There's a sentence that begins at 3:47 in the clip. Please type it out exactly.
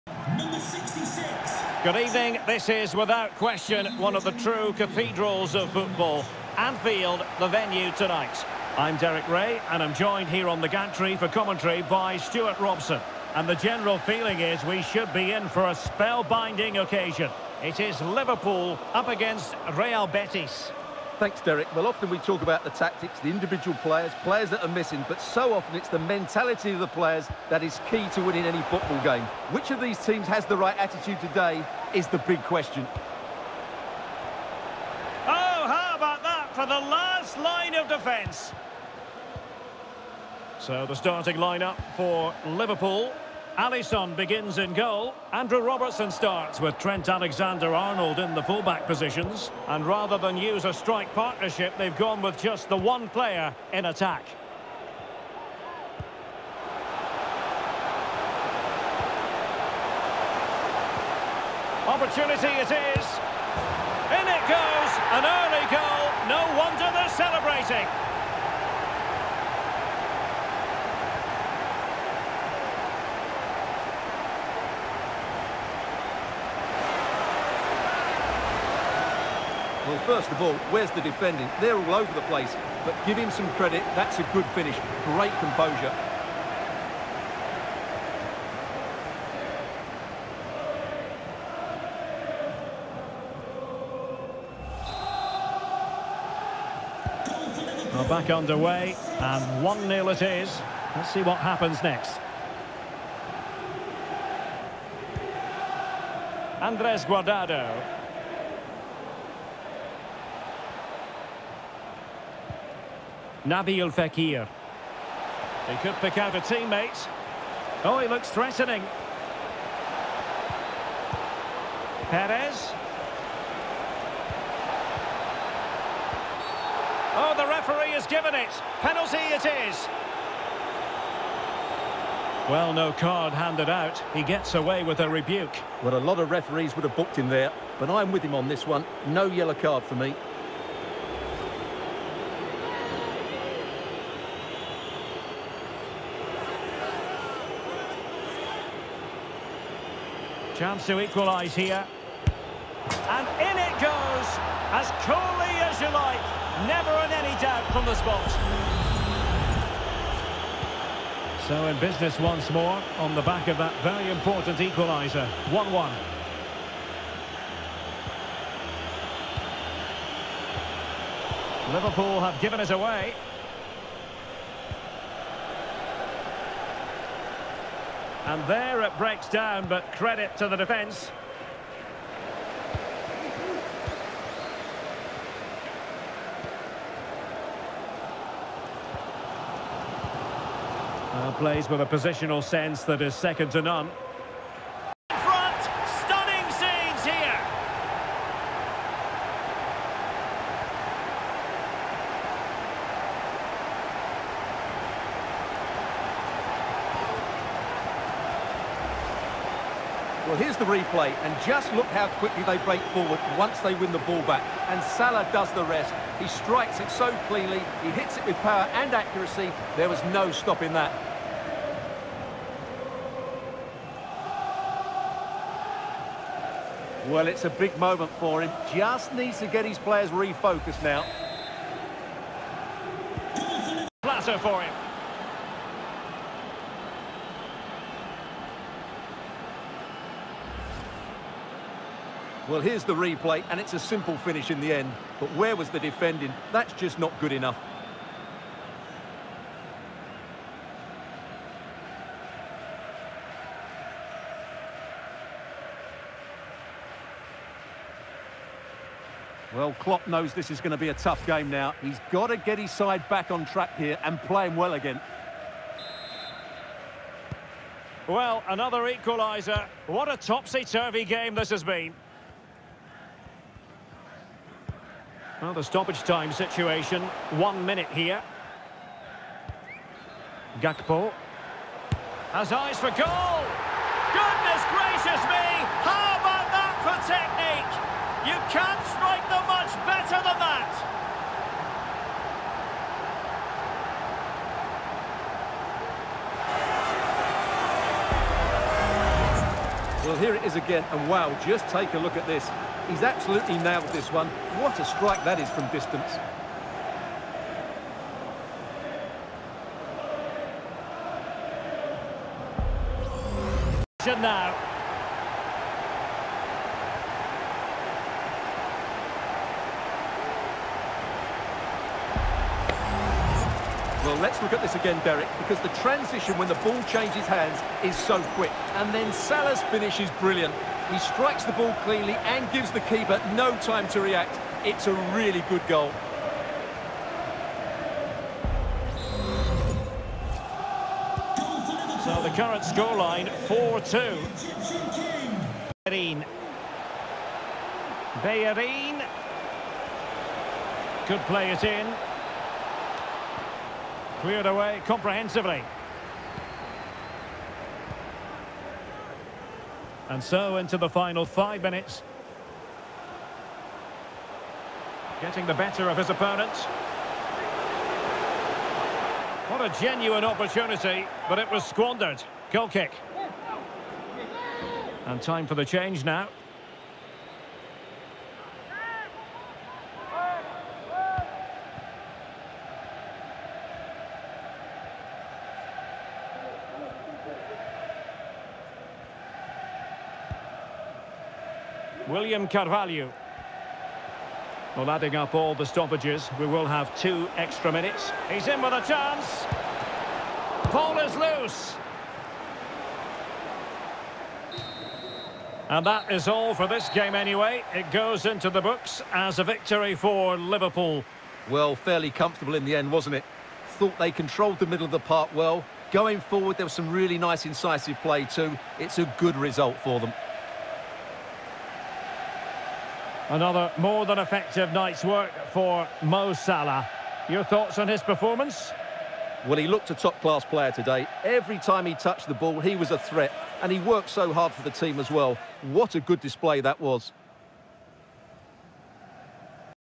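Well, it's a big moment for him.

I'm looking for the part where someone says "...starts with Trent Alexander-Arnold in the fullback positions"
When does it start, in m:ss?
0:46.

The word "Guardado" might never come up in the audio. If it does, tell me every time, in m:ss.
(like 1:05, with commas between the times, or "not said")
1:47.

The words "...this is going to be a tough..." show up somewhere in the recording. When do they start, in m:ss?
4:20.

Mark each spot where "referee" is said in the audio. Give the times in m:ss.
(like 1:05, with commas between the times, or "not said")
2:07, 2:16.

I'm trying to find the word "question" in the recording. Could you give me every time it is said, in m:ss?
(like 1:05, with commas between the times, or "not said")
0:03, 0:32.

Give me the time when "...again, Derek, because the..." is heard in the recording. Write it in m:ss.
5:24.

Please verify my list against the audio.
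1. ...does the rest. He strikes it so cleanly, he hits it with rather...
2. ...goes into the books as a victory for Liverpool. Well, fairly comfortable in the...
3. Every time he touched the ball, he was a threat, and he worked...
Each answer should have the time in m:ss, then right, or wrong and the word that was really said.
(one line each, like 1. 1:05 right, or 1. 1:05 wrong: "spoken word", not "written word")
1. 3:35 wrong: "power", not "rather"
2. 6:47 right
3. 7:11 right.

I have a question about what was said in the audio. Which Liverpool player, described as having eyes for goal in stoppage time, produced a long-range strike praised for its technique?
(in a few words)
Gakpo.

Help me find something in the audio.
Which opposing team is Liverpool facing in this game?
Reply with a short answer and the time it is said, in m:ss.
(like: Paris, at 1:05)
Real Betis, at 0:19.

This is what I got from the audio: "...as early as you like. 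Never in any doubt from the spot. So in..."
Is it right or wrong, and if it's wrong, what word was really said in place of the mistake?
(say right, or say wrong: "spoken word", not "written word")
wrong: "coolly", not "early".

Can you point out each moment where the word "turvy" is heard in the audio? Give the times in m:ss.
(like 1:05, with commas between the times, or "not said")
4:30.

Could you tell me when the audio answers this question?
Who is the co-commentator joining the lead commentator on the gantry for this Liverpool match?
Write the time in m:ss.
0:12.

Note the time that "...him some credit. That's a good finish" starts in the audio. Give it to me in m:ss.
1:23.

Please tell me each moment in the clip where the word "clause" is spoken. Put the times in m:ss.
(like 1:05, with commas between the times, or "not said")
not said.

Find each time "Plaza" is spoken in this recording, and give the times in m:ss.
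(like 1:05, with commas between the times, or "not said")
3:54.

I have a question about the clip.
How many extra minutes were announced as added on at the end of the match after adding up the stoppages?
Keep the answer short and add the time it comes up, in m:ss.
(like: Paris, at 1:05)
2, at 6:36.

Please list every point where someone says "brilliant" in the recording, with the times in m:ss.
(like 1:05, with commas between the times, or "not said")
5:30.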